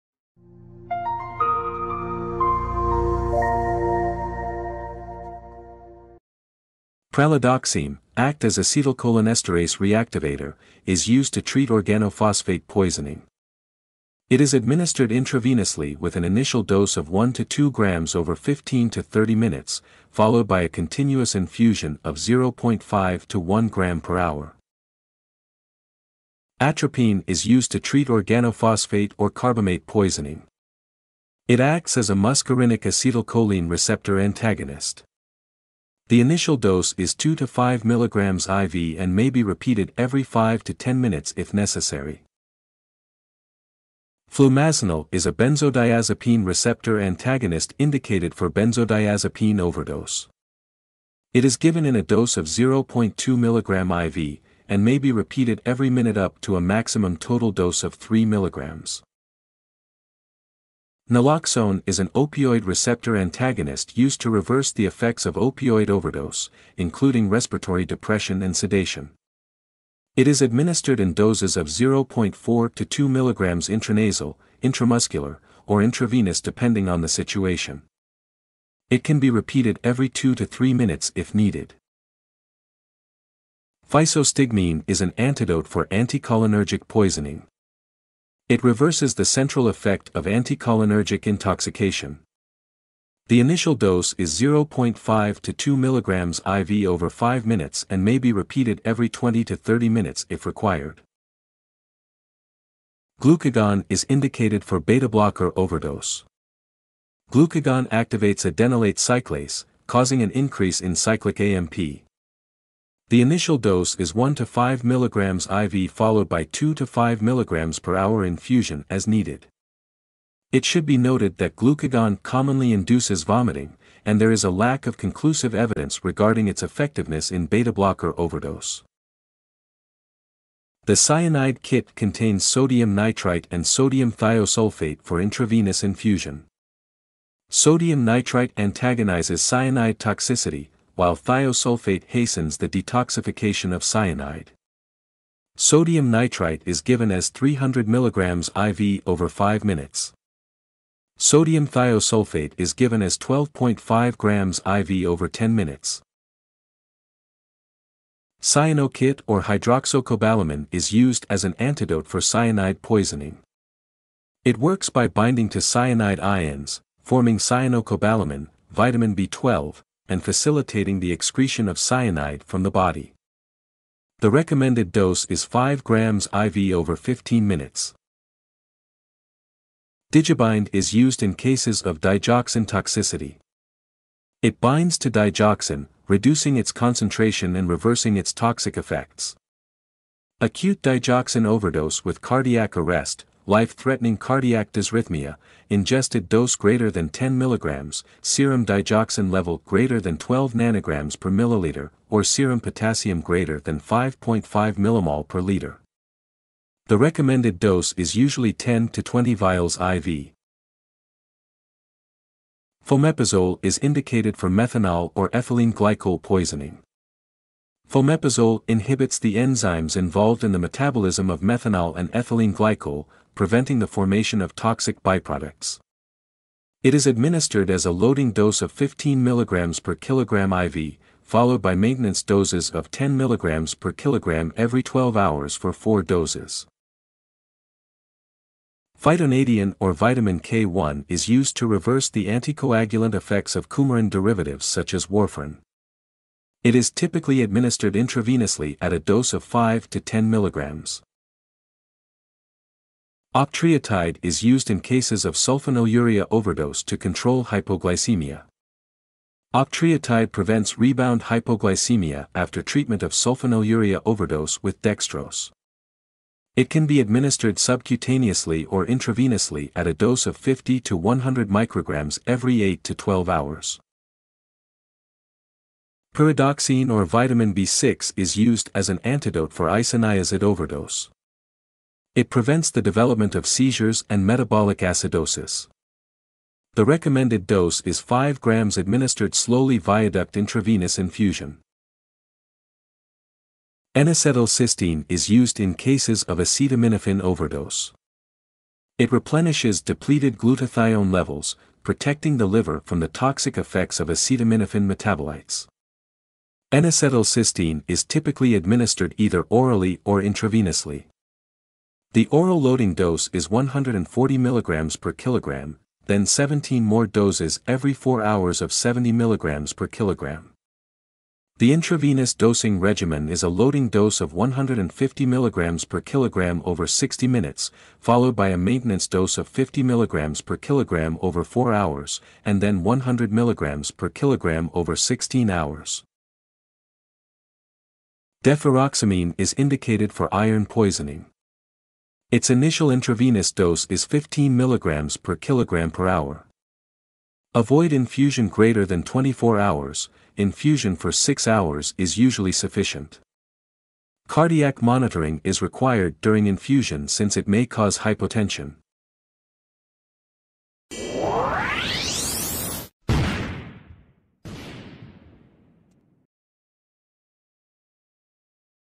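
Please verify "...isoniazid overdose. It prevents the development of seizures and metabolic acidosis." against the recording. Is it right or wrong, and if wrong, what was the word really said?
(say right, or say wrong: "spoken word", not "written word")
right.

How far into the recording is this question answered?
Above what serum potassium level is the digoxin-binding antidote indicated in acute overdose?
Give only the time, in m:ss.
3:23.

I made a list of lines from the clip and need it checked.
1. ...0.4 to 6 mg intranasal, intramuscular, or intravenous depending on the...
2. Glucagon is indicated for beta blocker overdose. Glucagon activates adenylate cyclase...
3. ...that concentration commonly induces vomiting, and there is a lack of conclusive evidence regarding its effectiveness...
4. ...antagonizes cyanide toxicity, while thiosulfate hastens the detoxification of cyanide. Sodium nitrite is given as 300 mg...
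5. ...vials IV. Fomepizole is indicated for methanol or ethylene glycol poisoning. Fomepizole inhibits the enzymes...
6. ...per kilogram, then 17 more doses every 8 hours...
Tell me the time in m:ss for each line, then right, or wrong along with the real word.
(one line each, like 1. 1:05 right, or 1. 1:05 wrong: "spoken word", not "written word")
1. 1:11 wrong: "2", not "6"
2. 1:43 right
3. 2:01 wrong: "glucagon", not "concentration"
4. 2:18 right
5. 3:29 right
6. 5:15 wrong: "4", not "8".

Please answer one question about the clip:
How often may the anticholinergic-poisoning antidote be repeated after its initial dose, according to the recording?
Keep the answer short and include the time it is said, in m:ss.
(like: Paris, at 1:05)
every 20 to 30 minutes, at 1:38.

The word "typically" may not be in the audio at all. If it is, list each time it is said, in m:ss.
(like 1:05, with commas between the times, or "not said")
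4:06, 5:08.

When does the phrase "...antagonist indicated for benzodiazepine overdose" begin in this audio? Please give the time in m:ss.
0:46.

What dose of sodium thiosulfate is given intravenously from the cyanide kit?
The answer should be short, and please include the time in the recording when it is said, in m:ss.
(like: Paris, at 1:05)
12.5 grams, at 2:33.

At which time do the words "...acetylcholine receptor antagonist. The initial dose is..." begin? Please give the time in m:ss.
0:32.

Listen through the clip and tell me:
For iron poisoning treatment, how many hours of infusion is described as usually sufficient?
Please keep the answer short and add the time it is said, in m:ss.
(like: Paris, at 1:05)
6 hours, at 5:51.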